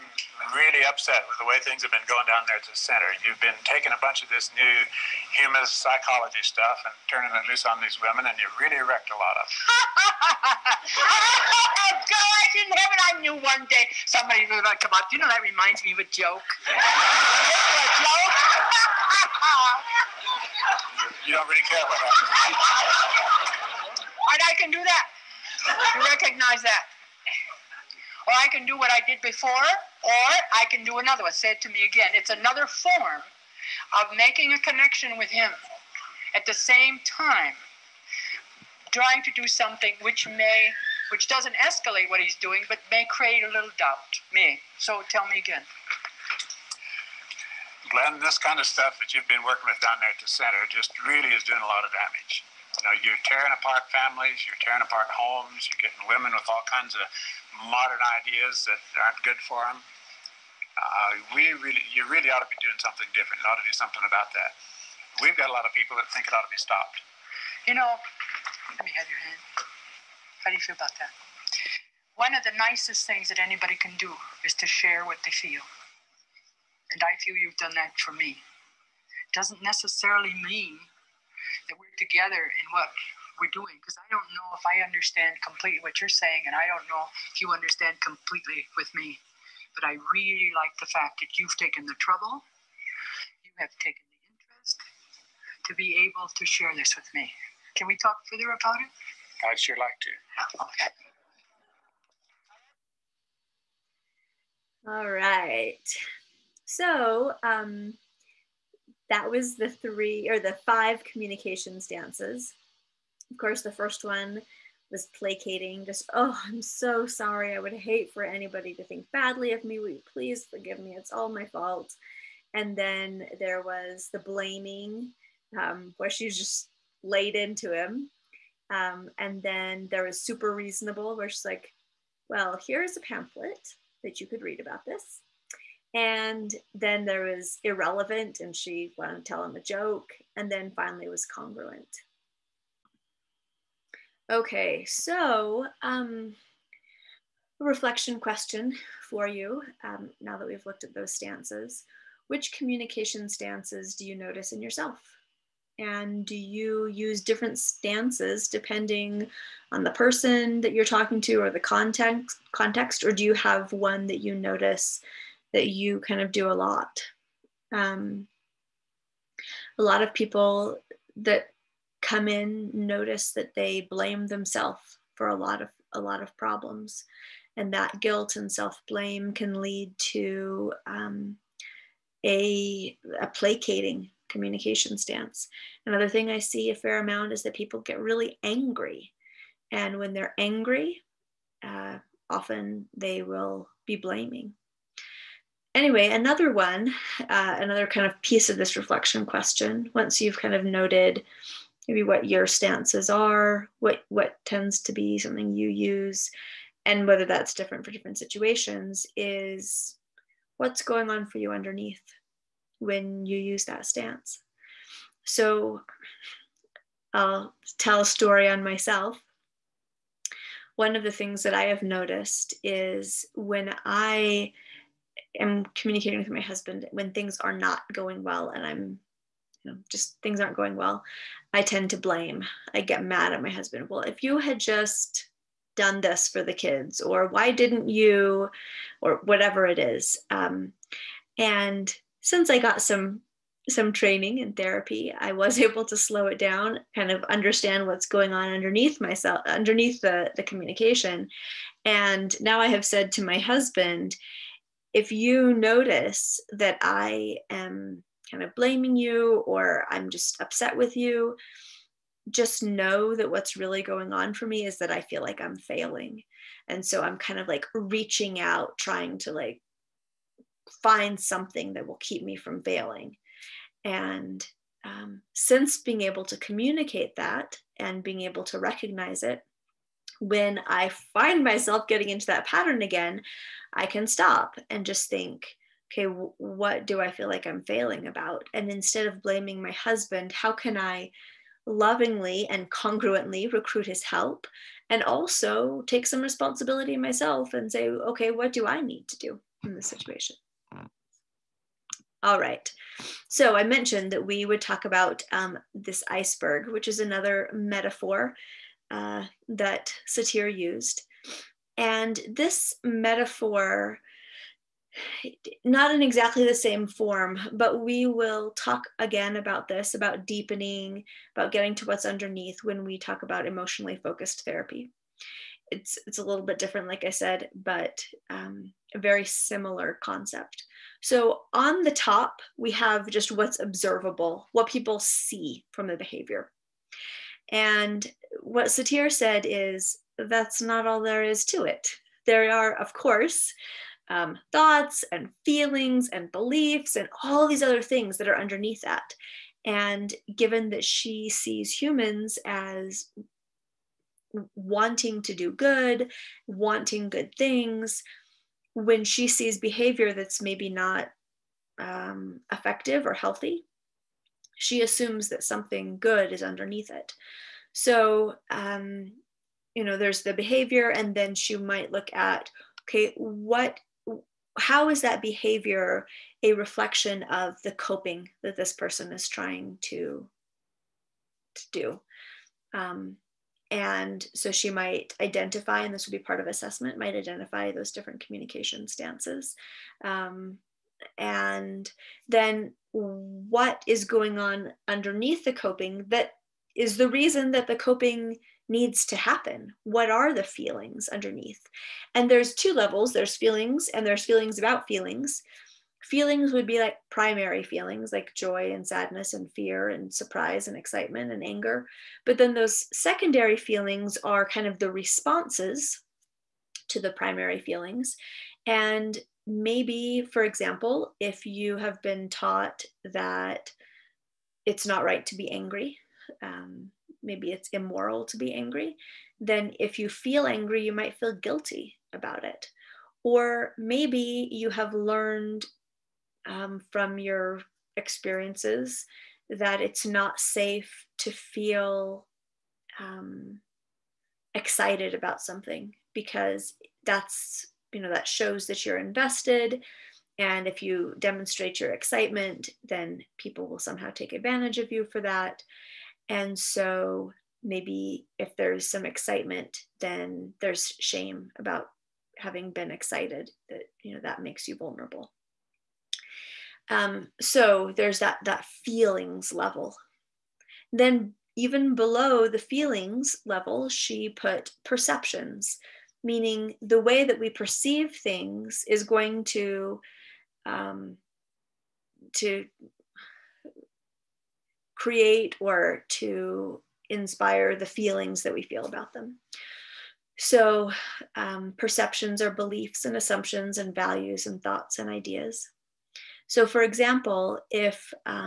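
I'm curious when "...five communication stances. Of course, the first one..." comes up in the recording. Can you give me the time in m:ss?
1:50.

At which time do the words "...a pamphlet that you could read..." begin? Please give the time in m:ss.
2:12.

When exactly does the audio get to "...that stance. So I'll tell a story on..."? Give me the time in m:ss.
3:33.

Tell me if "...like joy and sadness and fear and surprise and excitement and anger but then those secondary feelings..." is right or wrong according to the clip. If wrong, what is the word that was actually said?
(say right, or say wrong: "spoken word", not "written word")
right.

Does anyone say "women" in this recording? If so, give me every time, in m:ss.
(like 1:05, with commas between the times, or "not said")
0:07, 0:56.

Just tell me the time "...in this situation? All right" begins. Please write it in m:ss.
4:59.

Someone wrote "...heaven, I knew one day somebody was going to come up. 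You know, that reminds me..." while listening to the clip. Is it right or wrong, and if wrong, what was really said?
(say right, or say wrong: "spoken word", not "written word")
right.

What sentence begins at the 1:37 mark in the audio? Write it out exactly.
Can we talk further about it?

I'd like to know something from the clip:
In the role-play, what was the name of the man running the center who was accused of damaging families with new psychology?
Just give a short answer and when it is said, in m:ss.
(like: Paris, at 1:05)
Glenn, at 0:47.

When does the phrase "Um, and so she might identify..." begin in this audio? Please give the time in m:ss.
6:22.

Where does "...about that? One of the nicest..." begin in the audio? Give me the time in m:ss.
1:10.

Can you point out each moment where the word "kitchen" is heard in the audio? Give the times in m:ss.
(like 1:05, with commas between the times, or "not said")
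not said.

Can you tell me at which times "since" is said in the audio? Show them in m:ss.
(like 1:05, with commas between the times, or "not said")
4:02, 4:35.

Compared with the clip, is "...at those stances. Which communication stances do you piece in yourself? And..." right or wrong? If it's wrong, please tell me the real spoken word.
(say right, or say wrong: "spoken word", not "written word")
wrong: "notice", not "piece".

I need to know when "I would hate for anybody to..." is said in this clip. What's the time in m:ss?
1:57.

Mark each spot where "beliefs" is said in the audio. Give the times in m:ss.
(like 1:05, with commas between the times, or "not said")
5:46, 8:12.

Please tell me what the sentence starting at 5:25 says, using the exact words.
It's, it's a little bit different, like I said, but um, a very similar concept.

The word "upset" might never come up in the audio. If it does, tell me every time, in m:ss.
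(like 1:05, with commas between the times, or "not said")
0:00, 4:20.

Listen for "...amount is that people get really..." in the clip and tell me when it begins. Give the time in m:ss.
3:06.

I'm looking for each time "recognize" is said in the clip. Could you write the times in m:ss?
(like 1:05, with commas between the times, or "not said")
0:26, 4:38.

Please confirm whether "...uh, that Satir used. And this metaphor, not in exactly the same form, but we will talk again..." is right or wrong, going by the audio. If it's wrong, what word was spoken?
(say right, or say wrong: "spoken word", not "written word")
right.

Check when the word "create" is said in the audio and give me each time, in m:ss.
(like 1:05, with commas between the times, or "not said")
0:43, 8:05.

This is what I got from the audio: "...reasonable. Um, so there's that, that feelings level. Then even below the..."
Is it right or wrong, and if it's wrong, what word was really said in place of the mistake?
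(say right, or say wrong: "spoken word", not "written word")
wrong: "vulnerable", not "reasonable".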